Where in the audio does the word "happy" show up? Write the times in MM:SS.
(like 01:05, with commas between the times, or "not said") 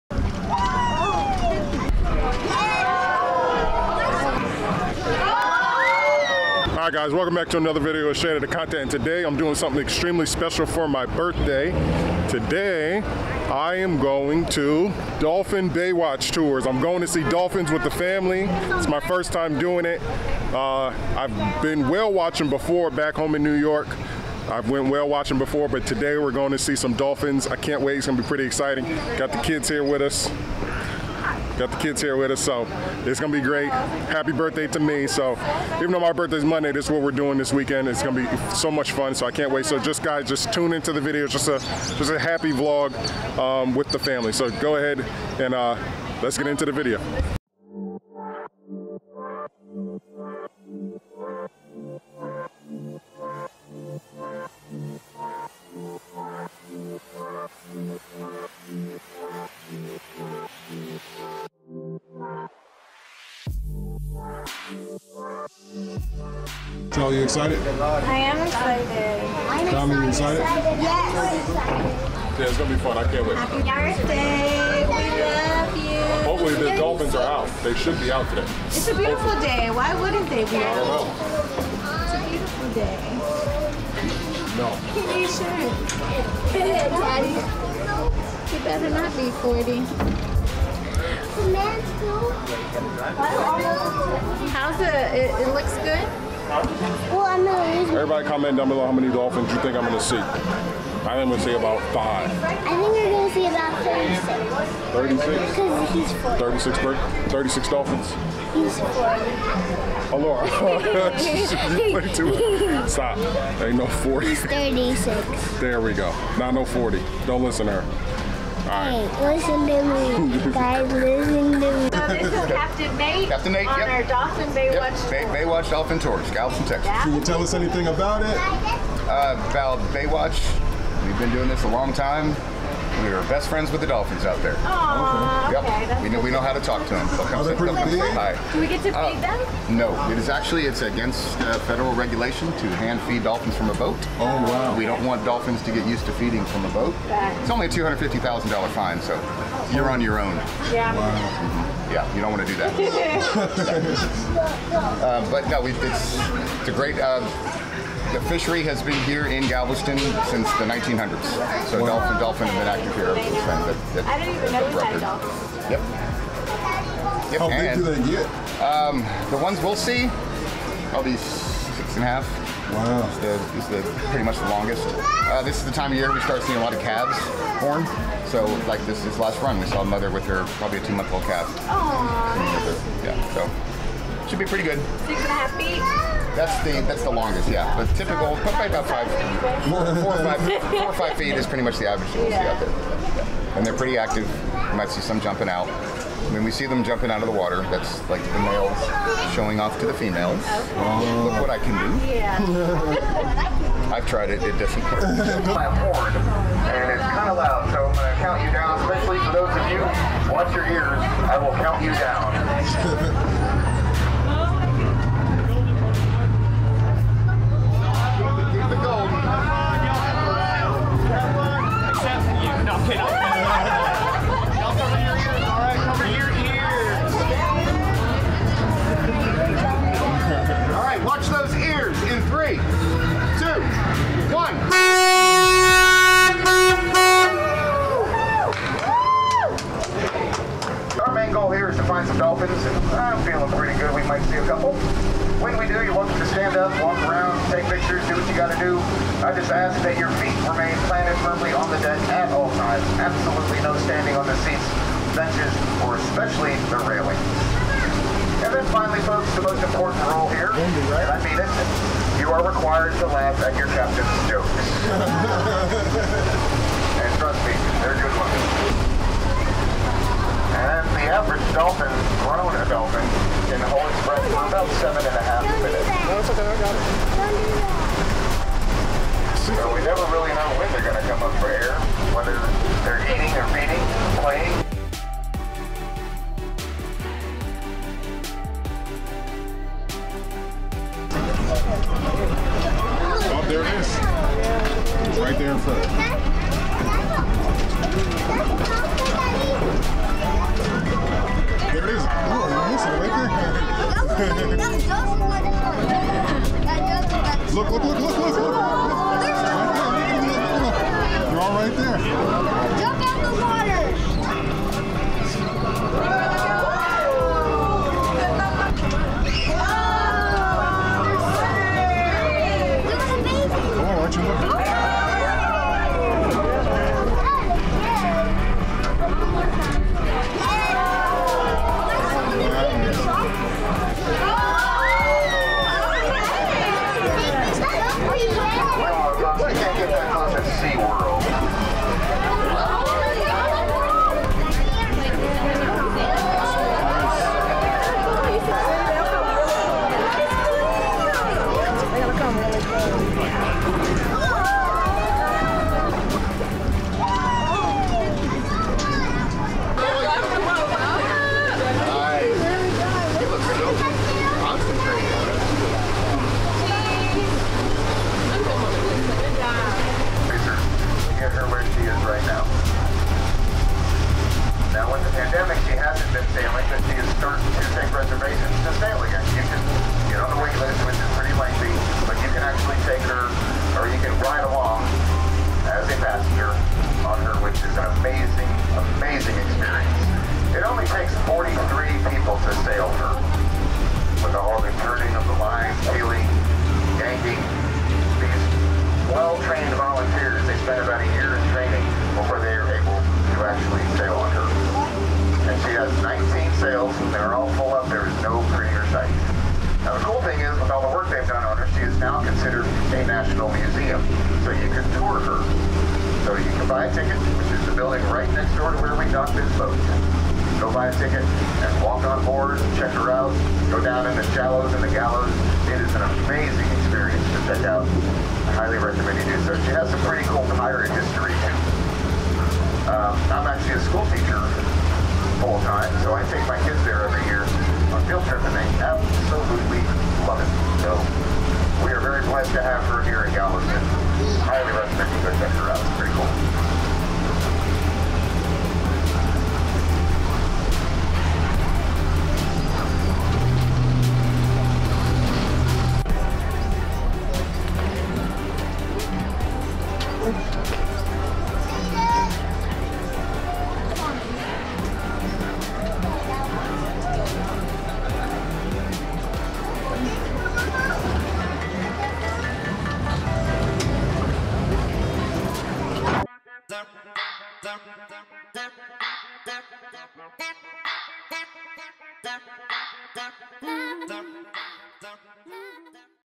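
00:33, 00:42, 01:13.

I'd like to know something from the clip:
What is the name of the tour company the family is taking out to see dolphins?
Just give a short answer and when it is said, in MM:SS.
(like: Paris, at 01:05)
Dolphin Baywatch Tours, at 00:15.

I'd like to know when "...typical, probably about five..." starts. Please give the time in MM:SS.
03:07.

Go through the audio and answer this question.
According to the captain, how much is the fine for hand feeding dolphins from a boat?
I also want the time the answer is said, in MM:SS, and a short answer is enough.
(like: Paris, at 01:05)
$250,000, at 02:27.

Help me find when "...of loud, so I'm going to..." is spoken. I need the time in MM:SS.
03:27.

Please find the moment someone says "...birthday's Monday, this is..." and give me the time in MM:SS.
00:36.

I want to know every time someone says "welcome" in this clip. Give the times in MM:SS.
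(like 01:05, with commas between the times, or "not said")
00:07, 04:05.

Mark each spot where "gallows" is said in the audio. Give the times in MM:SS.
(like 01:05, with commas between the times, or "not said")
07:04.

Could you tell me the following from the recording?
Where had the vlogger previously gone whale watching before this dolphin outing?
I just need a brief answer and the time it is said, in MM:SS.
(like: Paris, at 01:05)
New York, at 00:23.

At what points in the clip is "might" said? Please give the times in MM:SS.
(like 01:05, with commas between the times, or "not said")
03:14, 04:04.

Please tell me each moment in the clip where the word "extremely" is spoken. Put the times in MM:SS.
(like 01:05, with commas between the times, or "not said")
00:09.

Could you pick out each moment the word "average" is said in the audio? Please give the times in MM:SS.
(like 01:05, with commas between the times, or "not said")
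03:11, 04:31.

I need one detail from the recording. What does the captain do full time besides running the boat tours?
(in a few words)
School teacher.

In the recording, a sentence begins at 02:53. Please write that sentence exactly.
It's the, it's the pretty much the longest.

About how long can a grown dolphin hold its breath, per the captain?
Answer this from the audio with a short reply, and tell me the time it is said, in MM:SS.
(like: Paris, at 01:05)
7.5 minutes, at 04:34.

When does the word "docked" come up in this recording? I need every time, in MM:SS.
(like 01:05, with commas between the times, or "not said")
06:59.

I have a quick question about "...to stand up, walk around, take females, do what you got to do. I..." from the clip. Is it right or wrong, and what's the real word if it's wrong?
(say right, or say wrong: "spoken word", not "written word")
wrong: "pictures", not "females".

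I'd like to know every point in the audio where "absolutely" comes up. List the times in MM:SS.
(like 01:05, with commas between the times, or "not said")
04:13, 07:18.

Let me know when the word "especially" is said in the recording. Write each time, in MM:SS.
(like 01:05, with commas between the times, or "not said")
03:28, 04:15.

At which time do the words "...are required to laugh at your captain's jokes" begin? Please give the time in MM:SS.
04:22.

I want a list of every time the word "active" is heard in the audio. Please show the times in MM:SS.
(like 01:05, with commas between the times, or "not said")
02:42, 03:13.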